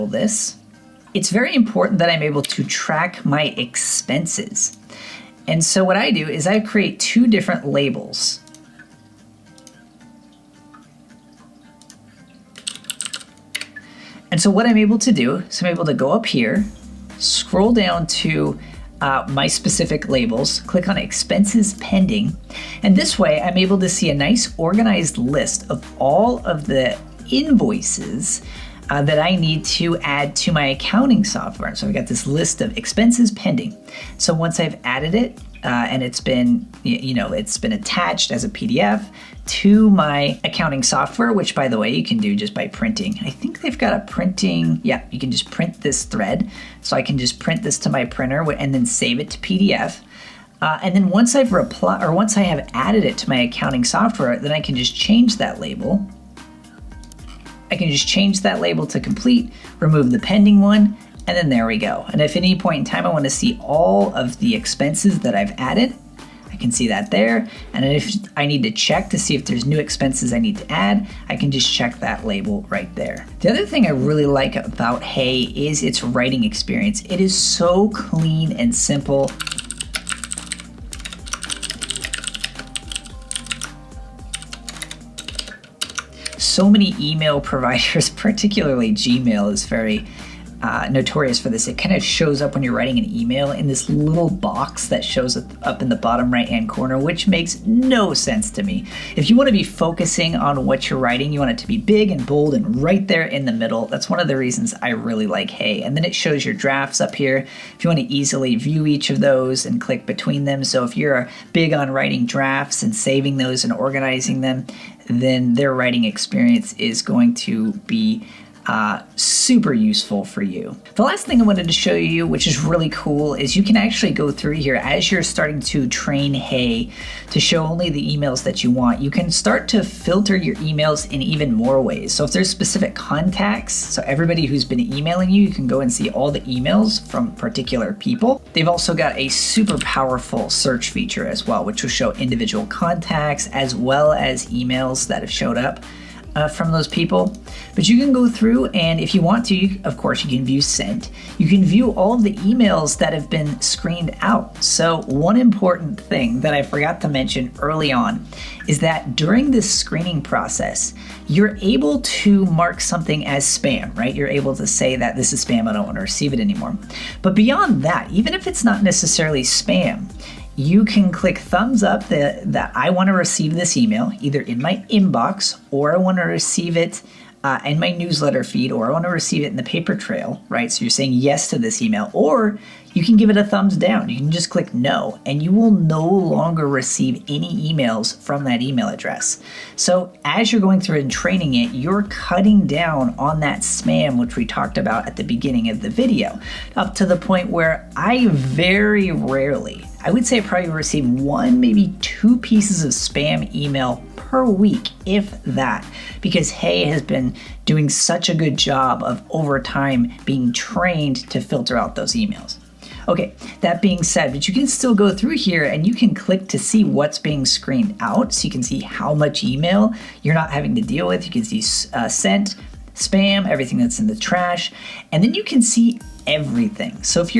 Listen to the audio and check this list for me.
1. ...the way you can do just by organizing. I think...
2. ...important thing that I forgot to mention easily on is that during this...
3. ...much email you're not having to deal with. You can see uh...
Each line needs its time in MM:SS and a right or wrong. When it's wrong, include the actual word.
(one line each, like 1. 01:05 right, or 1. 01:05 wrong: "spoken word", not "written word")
1. 00:41 wrong: "printing", not "organizing"
2. 02:35 wrong: "early", not "easily"
3. 03:39 right.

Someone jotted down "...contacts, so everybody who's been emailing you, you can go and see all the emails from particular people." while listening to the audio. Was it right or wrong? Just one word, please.
right.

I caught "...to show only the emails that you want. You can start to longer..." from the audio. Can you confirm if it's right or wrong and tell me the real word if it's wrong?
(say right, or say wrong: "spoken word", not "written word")
wrong: "filter", not "longer".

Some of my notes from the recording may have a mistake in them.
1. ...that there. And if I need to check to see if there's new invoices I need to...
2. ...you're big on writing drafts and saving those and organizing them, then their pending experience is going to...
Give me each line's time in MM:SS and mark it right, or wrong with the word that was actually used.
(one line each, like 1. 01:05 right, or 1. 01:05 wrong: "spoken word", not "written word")
1. 01:06 wrong: "expenses", not "invoices"
2. 01:50 wrong: "writing", not "pending".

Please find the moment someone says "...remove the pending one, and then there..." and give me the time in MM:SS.
00:59.